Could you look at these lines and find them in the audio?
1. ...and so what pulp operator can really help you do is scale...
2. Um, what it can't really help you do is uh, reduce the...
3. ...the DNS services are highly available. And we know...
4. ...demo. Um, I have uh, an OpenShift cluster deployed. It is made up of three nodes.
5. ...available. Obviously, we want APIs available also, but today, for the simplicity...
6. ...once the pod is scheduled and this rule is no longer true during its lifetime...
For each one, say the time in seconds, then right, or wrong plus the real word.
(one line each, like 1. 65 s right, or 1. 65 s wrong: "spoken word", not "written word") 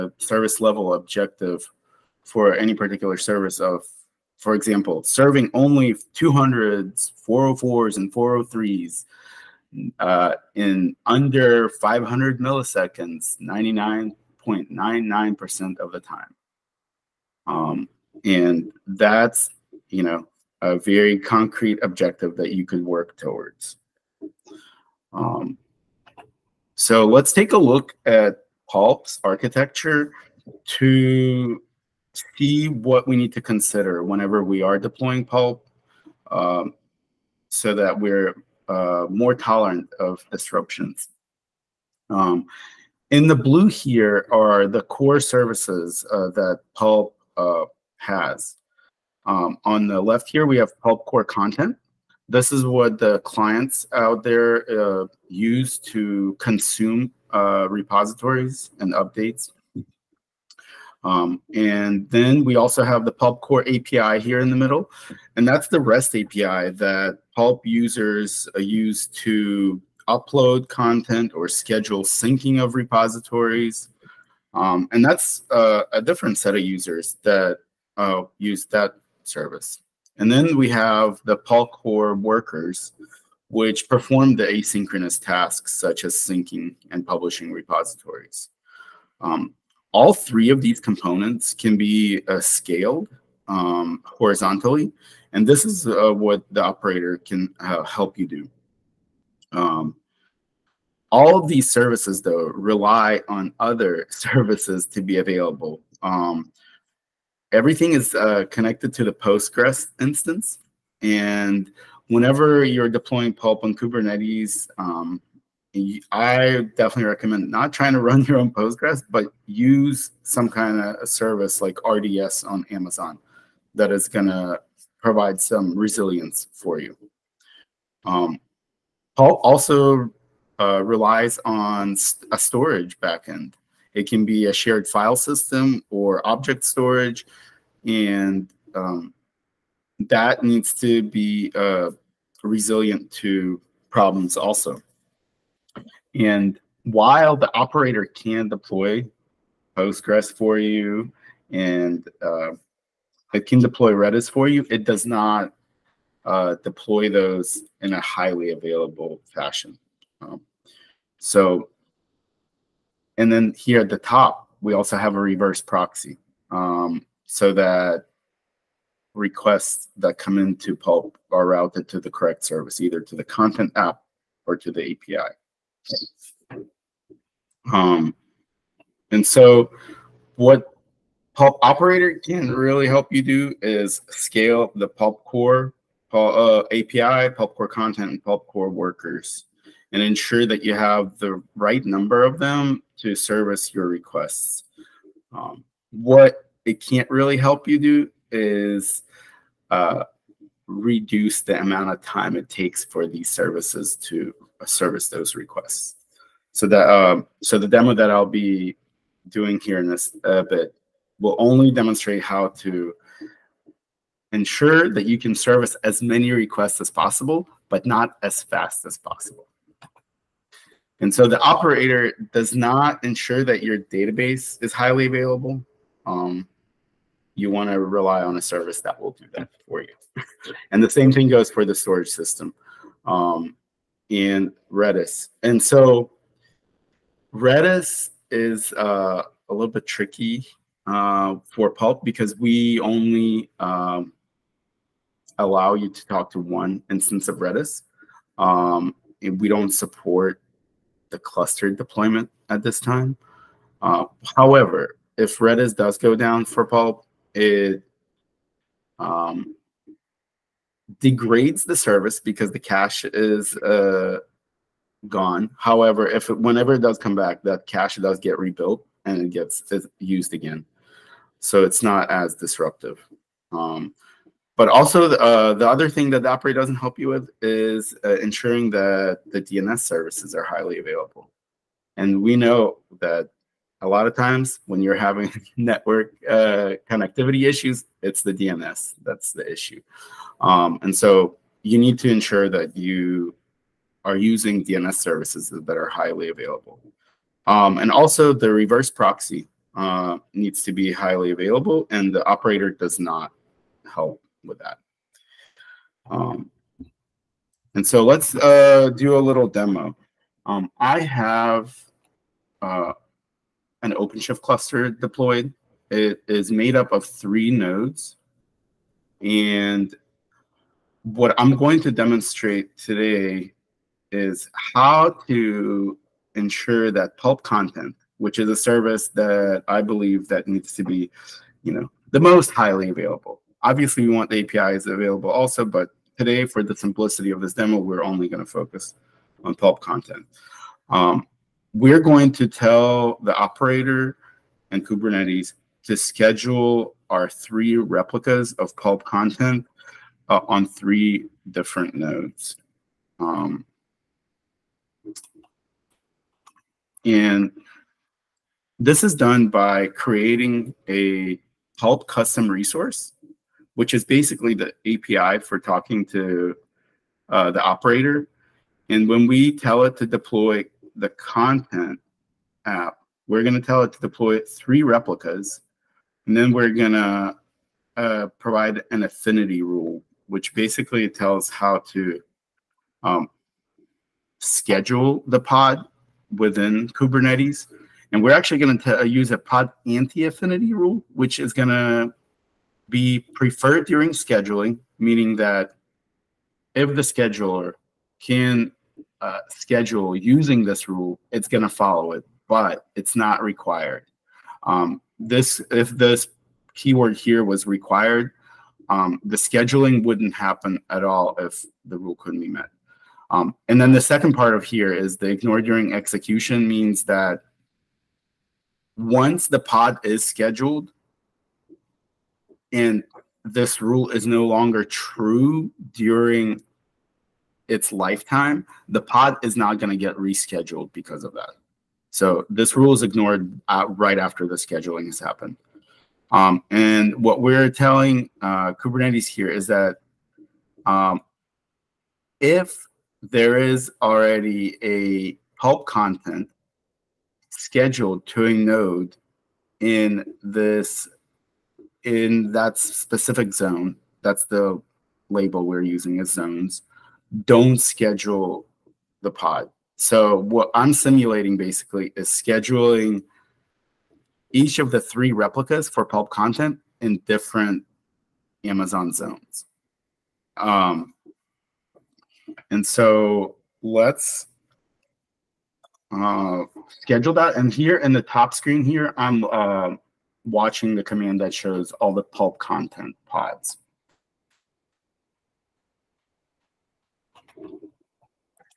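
1. 179 s right
2. 195 s right
3. 279 s right
4. 309 s right
5. 332 s right
6. 418 s right.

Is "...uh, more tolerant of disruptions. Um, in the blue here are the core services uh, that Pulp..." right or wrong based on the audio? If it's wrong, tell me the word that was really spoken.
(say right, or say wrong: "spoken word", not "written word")
right.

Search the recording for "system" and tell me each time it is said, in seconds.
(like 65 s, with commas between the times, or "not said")
135 s, 232 s.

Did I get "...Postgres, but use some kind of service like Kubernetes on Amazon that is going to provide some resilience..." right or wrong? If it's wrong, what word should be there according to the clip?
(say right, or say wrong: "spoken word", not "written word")
wrong: "RDS", not "Kubernetes".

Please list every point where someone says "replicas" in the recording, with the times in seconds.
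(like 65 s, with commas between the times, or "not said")
347 s, 374 s, 465 s.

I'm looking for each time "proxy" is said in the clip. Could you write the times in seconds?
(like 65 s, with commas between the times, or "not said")
165 s, 298 s.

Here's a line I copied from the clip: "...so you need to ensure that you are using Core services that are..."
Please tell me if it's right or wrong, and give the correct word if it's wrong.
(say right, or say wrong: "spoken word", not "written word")
wrong: "DNS", not "Core".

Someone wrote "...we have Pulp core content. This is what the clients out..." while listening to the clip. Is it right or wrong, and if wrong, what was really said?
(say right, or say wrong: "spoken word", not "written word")
right.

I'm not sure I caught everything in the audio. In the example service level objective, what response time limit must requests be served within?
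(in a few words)
500 milliseconds.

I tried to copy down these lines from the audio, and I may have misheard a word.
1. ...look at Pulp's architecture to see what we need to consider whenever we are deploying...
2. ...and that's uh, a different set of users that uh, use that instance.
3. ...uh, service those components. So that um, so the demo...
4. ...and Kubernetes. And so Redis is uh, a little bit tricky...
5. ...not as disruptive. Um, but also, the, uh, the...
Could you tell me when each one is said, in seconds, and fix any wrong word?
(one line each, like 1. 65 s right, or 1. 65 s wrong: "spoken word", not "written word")
1. 27 s right
2. 74 s wrong: "service", not "instance"
3. 204 s wrong: "requests", not "components"
4. 234 s wrong: "Redis", not "Kubernetes"
5. 271 s right.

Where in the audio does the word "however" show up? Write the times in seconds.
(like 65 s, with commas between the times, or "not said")
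254 s, 265 s.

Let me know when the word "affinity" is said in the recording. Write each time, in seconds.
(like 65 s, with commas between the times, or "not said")
379 s, 389 s.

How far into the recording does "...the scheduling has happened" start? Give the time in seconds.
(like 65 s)
434 s.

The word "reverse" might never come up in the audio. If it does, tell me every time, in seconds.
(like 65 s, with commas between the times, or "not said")
165 s, 298 s.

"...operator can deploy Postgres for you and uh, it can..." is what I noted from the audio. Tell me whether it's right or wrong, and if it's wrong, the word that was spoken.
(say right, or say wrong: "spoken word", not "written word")
right.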